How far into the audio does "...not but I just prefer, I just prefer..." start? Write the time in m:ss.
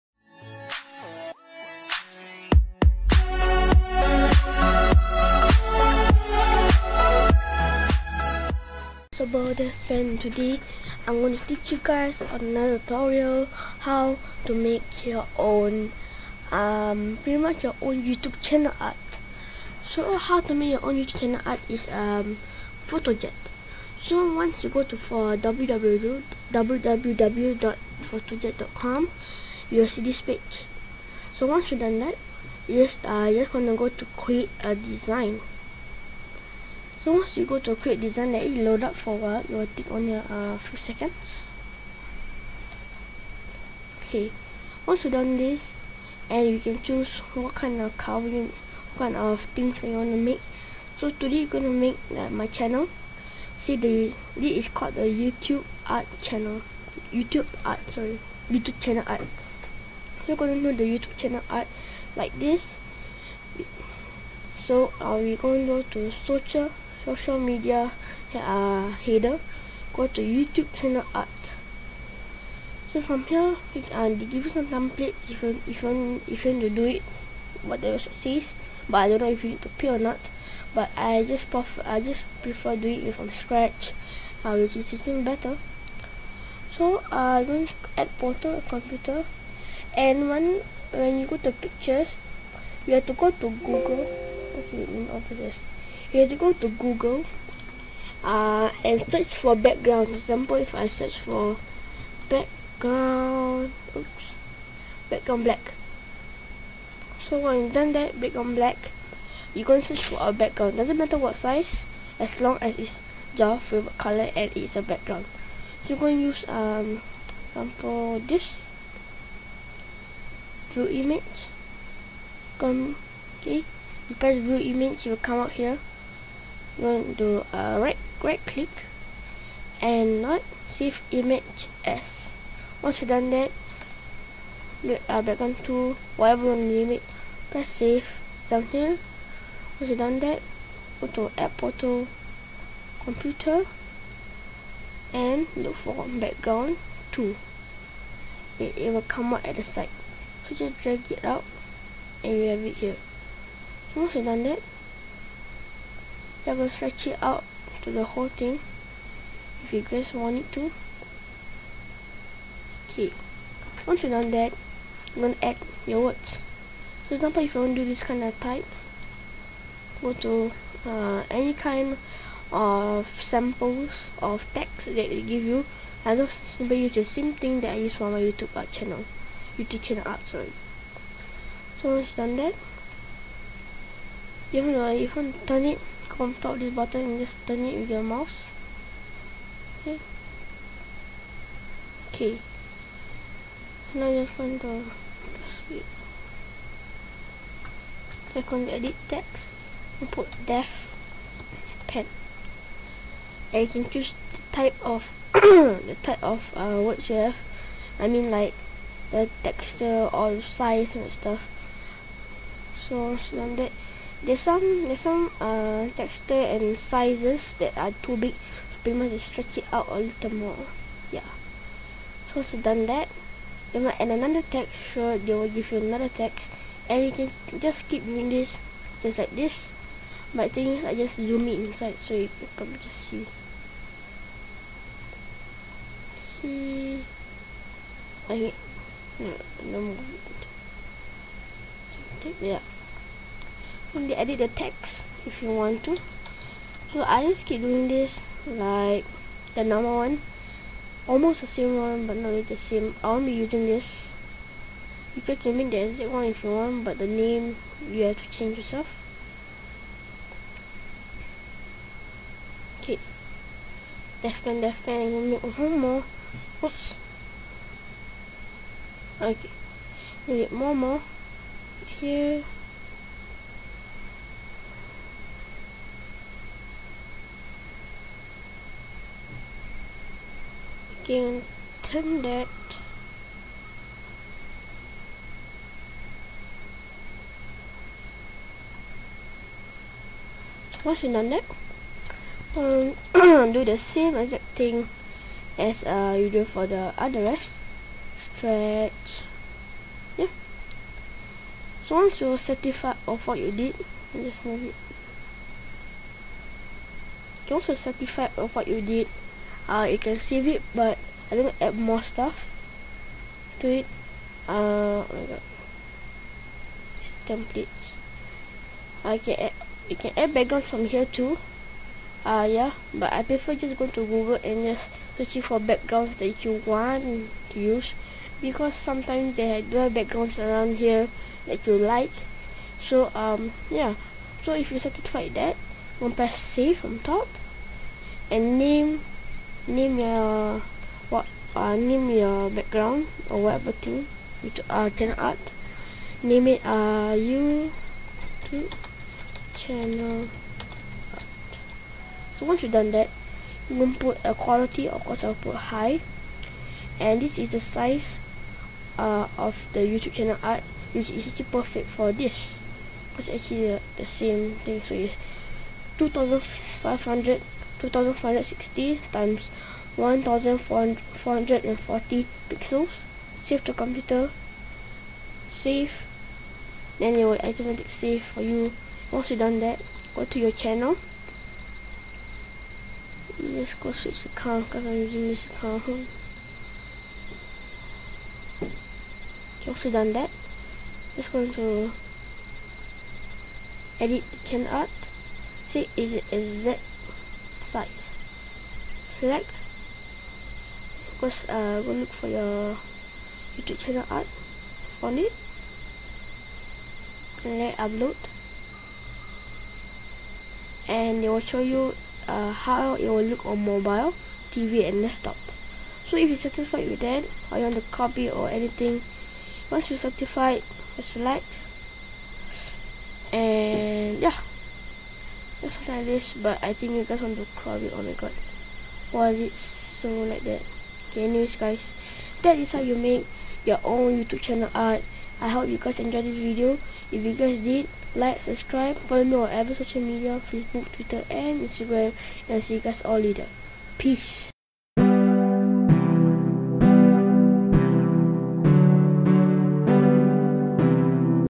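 1:19.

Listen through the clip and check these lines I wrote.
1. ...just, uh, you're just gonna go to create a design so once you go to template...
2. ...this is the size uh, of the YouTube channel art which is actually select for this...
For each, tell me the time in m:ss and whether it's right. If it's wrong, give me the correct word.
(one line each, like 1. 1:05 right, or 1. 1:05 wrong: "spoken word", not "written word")
1. 0:32 wrong: "create", not "template"
2. 5:57 wrong: "perfect", not "select".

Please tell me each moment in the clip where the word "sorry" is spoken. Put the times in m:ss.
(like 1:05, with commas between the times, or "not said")
0:57, 3:00.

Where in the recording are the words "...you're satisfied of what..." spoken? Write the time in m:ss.
5:02.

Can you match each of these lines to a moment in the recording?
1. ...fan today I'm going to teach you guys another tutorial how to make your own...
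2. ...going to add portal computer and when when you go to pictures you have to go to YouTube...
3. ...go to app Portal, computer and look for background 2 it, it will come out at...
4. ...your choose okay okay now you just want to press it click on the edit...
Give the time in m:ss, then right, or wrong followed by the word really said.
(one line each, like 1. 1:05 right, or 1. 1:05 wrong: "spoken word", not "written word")
1. 0:09 right
2. 1:27 wrong: "Google", not "YouTube"
3. 2:20 right
4. 3:07 wrong: "mouse", not "choose".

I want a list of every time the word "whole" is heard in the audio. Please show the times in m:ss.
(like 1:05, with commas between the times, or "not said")
2:38.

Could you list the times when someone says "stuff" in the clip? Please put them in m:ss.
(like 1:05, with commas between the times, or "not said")
3:31, 5:12.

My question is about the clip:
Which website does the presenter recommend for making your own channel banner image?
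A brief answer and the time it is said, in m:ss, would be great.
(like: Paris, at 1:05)
FotoJet, at 0:22.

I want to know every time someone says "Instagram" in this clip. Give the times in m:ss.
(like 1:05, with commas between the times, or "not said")
7:21.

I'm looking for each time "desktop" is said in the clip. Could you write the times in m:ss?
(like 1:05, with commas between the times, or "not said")
6:55.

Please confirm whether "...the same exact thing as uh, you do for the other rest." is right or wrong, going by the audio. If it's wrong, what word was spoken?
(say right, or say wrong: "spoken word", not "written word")
right.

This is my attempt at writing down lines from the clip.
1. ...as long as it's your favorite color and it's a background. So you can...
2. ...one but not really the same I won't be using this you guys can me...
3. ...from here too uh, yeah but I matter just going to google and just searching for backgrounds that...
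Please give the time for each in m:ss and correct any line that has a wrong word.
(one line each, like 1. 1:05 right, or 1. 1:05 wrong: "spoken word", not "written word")
1. 1:52 right
2. 4:11 right
3. 5:20 wrong: "prefer", not "matter".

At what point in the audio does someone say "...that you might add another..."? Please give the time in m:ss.
3:42.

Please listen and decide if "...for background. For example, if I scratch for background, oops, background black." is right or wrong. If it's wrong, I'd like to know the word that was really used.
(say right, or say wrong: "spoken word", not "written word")
wrong: "search", not "scratch".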